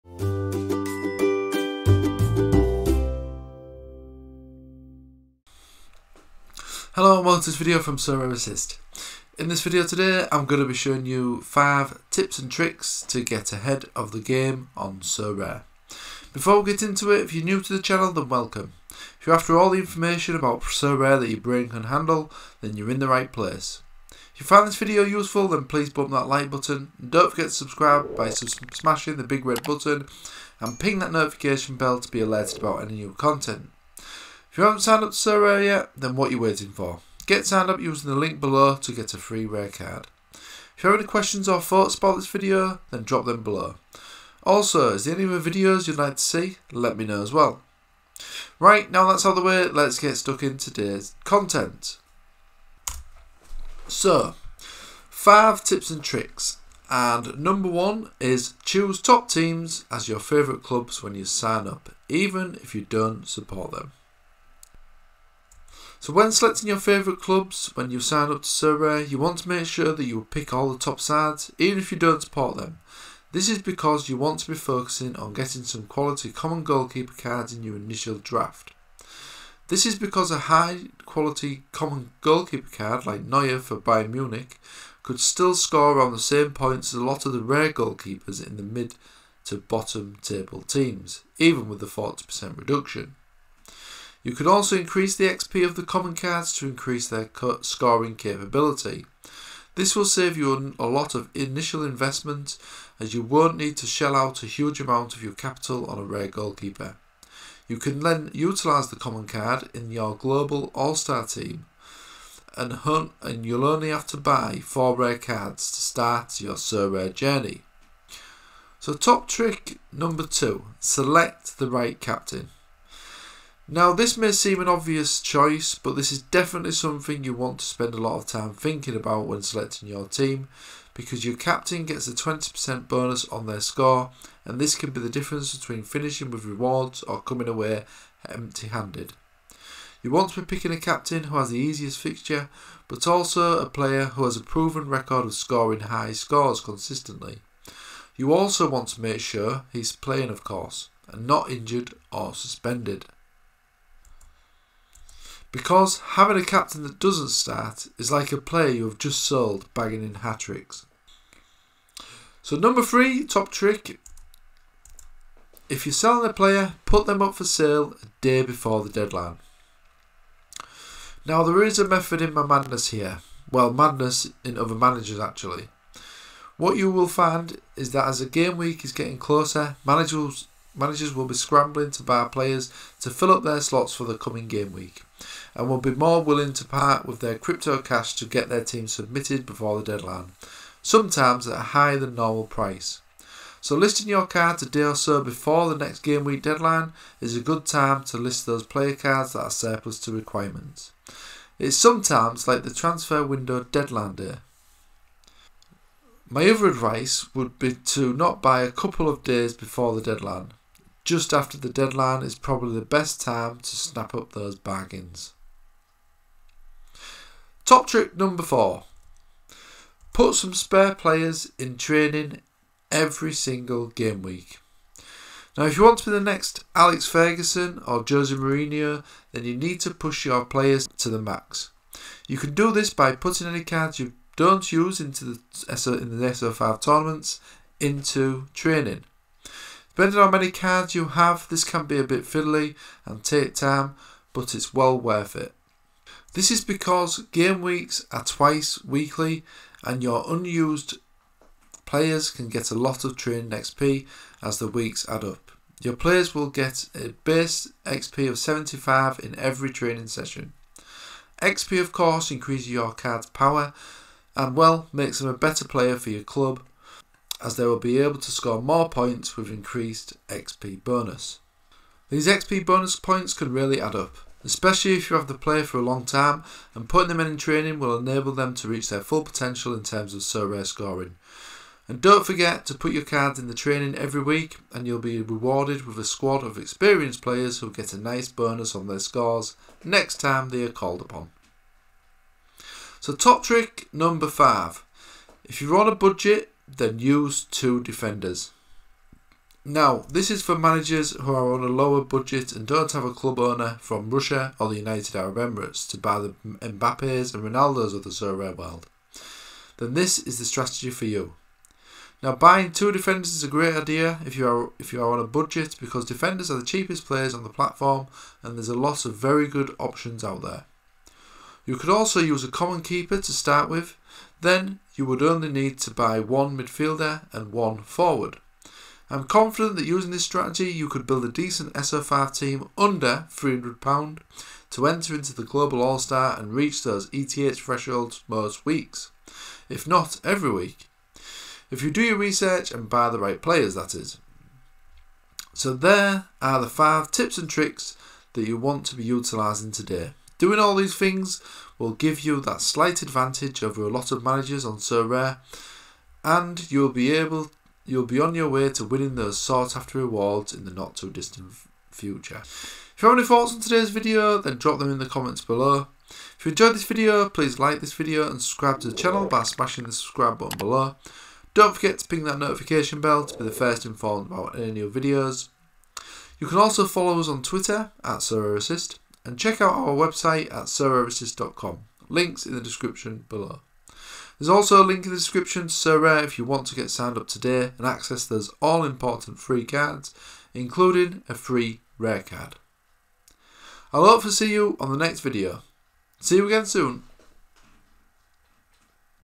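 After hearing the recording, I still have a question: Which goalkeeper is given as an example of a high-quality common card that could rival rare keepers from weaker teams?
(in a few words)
Neuer.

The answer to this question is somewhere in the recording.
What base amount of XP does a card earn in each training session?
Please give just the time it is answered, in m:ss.
4:18.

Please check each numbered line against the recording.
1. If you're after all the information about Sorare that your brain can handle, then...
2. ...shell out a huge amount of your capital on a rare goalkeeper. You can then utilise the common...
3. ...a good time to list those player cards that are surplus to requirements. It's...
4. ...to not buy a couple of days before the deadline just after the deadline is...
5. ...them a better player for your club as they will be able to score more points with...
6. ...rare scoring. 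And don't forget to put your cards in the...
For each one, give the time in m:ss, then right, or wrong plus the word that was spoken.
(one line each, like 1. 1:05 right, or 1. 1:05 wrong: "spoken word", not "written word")
1. 0:19 right
2. 1:43 right
3. 3:17 right
4. 3:27 right
5. 4:25 right
6. 4:40 right.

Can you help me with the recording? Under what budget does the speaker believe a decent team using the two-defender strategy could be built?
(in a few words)
£300.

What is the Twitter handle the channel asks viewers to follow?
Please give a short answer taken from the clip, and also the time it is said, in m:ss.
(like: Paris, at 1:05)
SorareAssist, at 6:18.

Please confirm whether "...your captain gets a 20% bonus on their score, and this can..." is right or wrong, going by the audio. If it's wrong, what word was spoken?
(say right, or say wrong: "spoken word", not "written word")
right.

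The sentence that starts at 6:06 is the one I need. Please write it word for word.
If you enjoyed this video, please like this video and subscribe to the channel by smashing the subscribe button below.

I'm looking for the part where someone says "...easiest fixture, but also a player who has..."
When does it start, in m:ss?
2:21.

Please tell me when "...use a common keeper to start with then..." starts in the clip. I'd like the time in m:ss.
5:22.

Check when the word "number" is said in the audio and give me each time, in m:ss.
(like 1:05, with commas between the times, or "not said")
0:57, 1:59, 2:42, 3:38, 4:53.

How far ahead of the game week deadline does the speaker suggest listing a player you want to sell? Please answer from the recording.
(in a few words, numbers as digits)
A day.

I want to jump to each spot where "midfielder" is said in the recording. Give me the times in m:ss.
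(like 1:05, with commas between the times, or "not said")
5:26.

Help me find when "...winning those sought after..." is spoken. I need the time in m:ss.
5:58.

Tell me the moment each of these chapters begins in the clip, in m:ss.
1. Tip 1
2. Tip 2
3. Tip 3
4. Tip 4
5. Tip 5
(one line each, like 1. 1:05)
1. 0:48
2. 2:00
3. 2:42
4. 3:36
5. 4:53.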